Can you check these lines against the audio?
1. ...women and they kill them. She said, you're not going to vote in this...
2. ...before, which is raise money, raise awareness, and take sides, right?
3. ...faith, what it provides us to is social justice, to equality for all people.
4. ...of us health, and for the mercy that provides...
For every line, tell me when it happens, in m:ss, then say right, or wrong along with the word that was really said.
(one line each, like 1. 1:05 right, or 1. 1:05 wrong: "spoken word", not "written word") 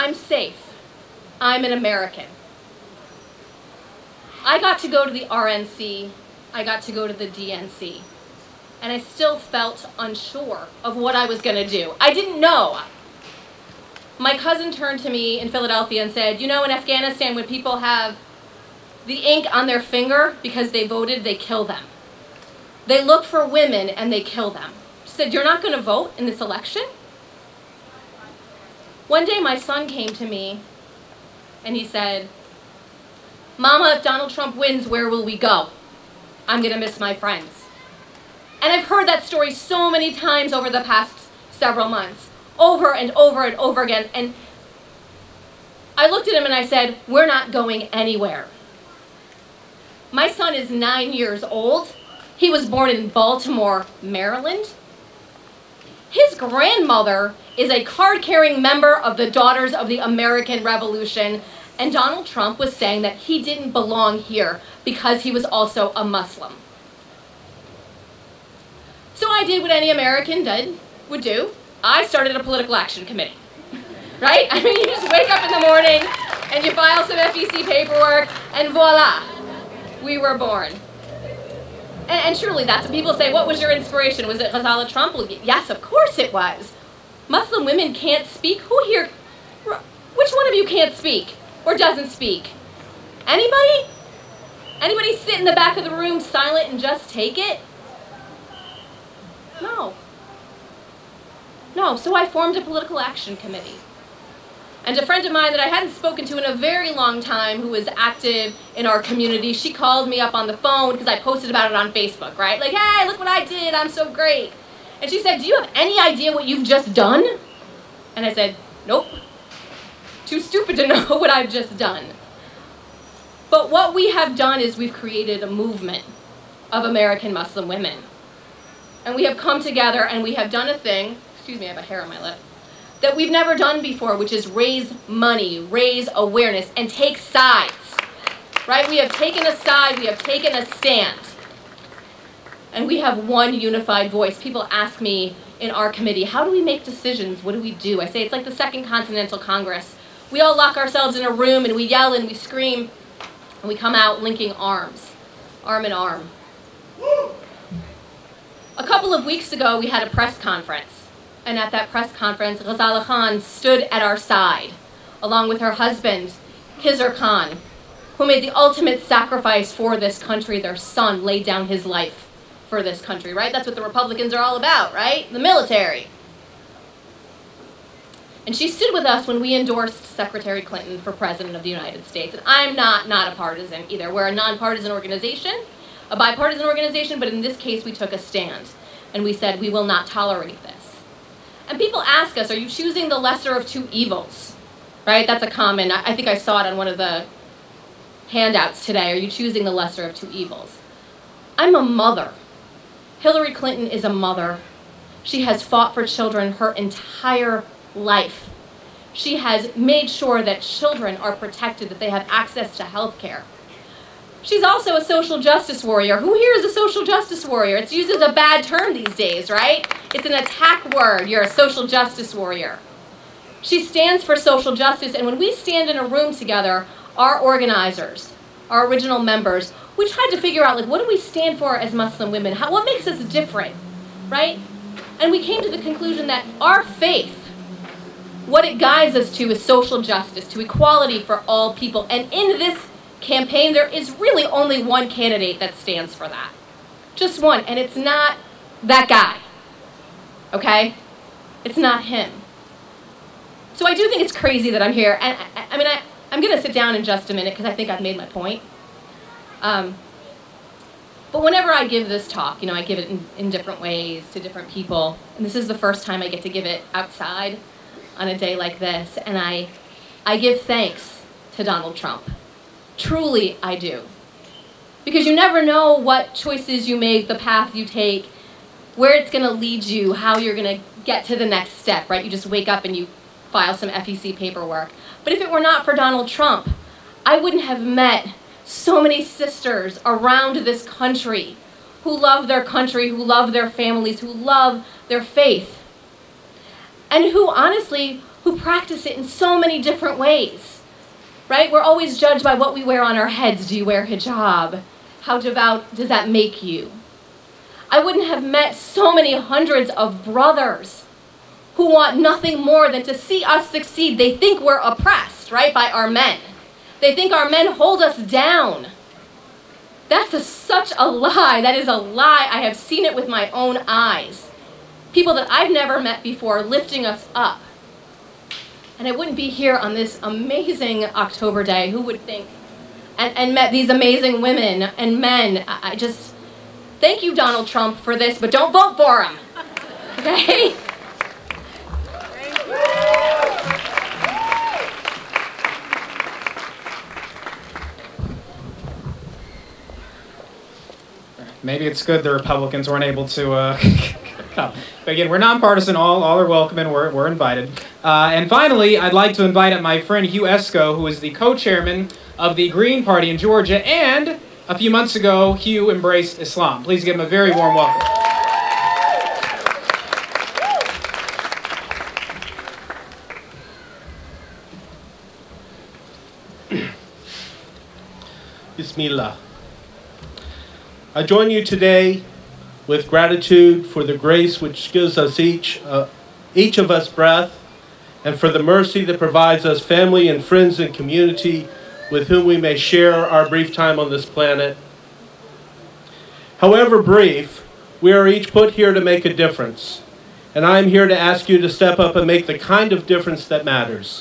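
1. 0:23 right
2. 2:13 right
3. 3:56 wrong: "guides", not "provides"
4. 6:26 wrong: "breath", not "health".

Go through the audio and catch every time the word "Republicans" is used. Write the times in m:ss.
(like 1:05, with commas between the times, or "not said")
2:53, 5:52.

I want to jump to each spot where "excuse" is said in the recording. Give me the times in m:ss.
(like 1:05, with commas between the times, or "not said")
2:11.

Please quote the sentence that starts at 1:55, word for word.
And she said, do you have any idea what you've just done?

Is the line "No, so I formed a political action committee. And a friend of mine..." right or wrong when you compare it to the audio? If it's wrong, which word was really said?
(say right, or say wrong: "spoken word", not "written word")
right.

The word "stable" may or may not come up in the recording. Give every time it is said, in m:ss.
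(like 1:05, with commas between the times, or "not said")
not said.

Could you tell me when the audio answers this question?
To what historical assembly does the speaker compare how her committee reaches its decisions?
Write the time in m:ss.
2:28.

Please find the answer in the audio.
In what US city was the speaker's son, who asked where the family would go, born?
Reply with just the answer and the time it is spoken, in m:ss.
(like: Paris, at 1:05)
Baltimore, at 0:53.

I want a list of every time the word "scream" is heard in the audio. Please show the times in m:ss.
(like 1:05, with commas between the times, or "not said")
2:32.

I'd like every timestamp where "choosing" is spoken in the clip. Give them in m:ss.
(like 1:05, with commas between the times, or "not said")
3:12, 3:19.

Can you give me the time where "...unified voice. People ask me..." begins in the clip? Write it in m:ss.
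2:23.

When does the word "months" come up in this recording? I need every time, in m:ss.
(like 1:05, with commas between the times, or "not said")
0:41, 6:04.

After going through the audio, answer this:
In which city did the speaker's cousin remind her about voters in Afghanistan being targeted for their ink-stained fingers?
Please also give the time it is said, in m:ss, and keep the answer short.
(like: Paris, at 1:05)
Philadelphia, at 0:15.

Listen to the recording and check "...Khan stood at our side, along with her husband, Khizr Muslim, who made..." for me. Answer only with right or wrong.
wrong.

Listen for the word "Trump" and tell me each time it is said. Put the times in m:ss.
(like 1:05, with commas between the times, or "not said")
0:34, 1:02, 1:24, 4:31, 4:46, 5:37.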